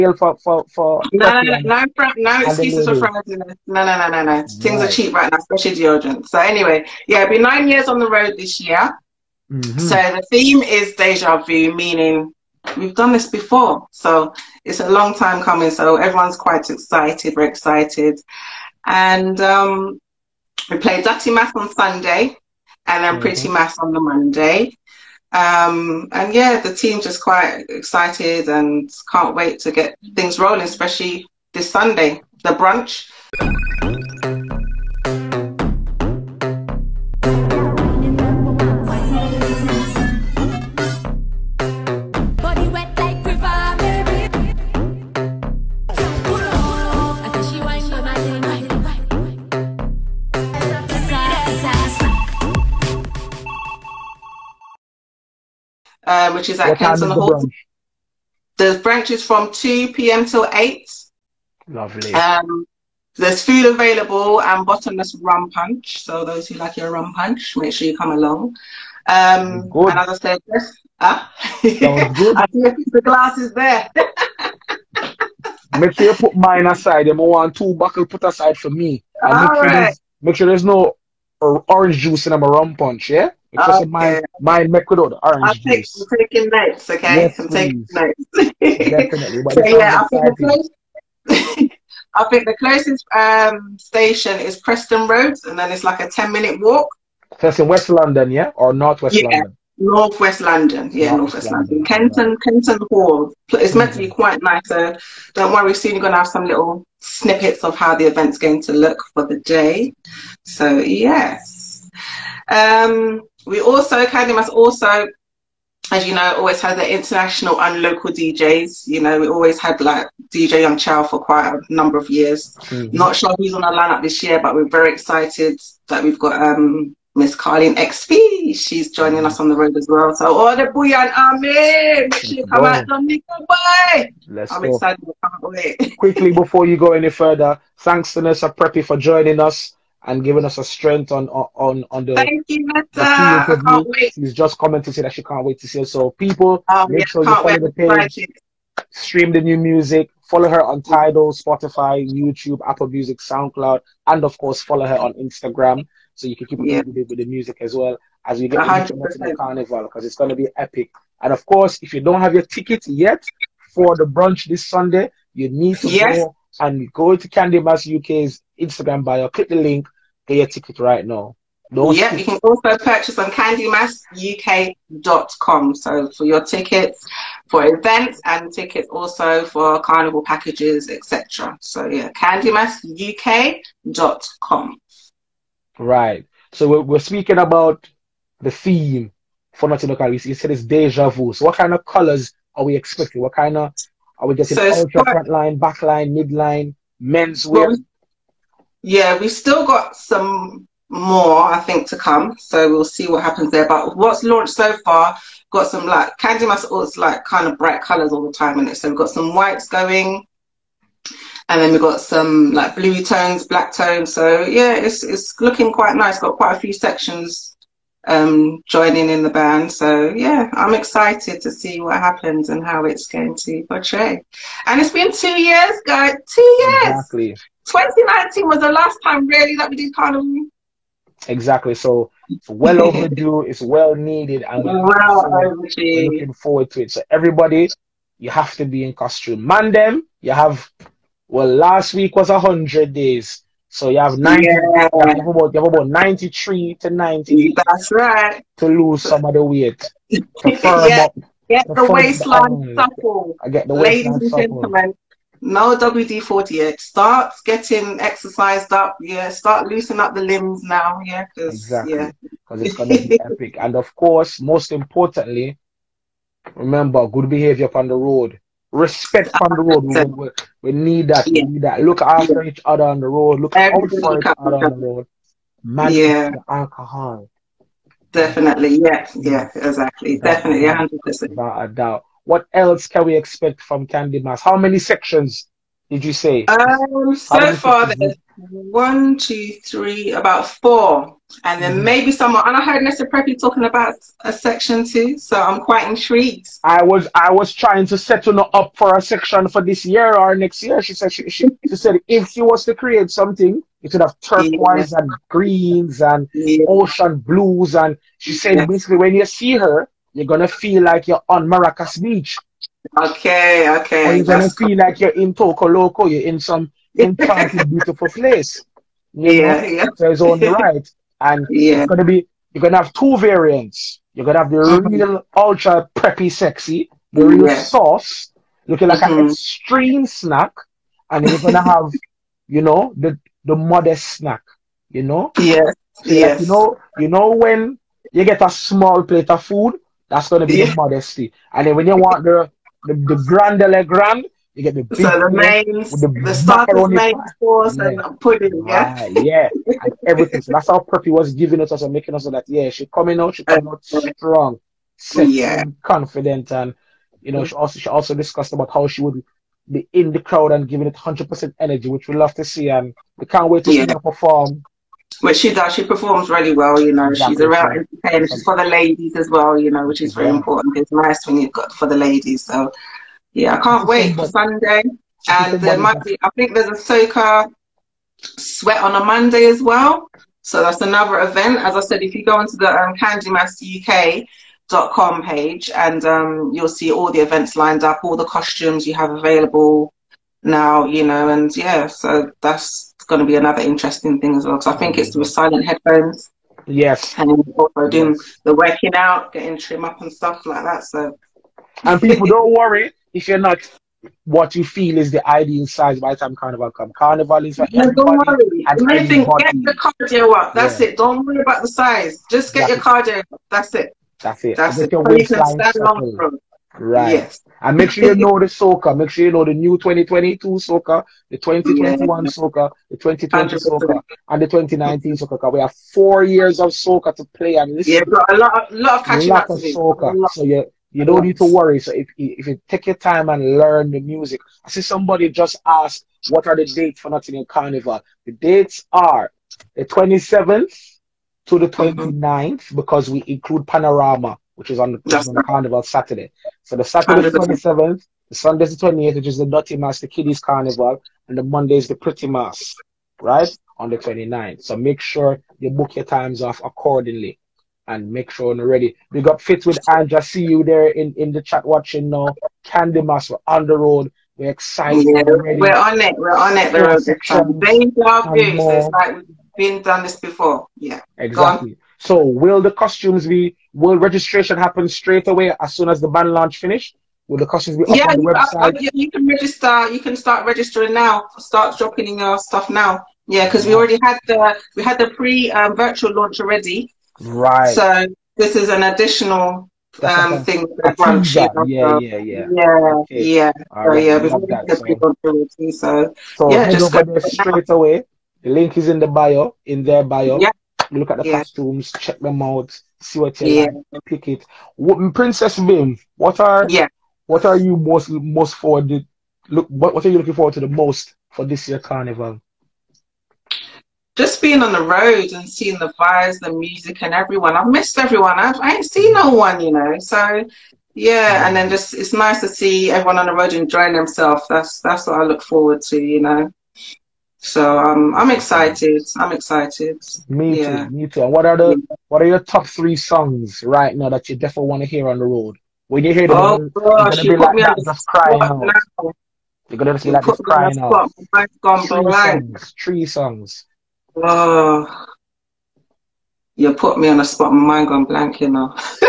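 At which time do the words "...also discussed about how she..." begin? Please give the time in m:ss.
5:57.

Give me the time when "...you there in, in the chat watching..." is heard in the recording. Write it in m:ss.
7:40.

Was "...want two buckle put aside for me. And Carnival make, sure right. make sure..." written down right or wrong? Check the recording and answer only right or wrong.
wrong.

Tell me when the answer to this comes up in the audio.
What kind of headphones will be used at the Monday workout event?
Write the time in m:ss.
6:35.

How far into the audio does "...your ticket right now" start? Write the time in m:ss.
2:50.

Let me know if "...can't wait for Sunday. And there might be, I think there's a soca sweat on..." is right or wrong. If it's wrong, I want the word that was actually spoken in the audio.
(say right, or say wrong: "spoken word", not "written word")
right.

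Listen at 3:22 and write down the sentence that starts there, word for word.
So we'll see what happens there.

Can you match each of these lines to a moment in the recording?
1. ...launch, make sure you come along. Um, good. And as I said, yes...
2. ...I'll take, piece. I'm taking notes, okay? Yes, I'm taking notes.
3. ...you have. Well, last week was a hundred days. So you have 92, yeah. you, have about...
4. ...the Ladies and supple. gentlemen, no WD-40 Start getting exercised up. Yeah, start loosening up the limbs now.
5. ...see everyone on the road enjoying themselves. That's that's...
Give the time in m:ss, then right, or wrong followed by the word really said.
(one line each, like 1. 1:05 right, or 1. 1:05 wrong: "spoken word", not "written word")
1. 1:07 wrong: "punch", not "launch"
2. 1:25 wrong: "juice", not "piece"
3. 4:00 wrong: "90", not "92"
4. 4:13 right
5. 8:42 right.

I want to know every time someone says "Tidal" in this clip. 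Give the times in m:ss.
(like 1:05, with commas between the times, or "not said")
2:30.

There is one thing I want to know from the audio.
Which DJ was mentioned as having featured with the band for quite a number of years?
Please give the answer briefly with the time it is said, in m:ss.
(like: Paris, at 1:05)
DJ Young Chow, at 2:00.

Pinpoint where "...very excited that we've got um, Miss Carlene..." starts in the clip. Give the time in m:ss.
2:04.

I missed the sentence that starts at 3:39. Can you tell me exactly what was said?
So yeah, I'm excited to see what happens and how it's going to portray.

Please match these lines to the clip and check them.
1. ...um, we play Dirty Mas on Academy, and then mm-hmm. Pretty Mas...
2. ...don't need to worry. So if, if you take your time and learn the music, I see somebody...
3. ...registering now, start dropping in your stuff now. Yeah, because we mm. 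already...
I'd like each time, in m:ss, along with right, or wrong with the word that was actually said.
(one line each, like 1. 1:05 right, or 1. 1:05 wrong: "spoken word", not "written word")
1. 0:19 wrong: "Sunday", not "Academy"
2. 7:11 right
3. 8:00 right.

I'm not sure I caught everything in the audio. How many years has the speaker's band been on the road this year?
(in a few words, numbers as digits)
9.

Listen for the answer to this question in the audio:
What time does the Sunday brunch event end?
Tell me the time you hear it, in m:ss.
1:00.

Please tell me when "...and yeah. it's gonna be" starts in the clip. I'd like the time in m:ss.
5:21.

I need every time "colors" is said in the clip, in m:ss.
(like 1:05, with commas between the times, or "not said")
3:11, 3:27.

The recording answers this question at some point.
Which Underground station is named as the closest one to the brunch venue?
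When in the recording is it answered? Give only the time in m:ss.
1:34.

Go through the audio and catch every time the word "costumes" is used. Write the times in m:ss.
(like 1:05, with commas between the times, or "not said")
3:58, 6:28, 7:52, 7:57, 8:21.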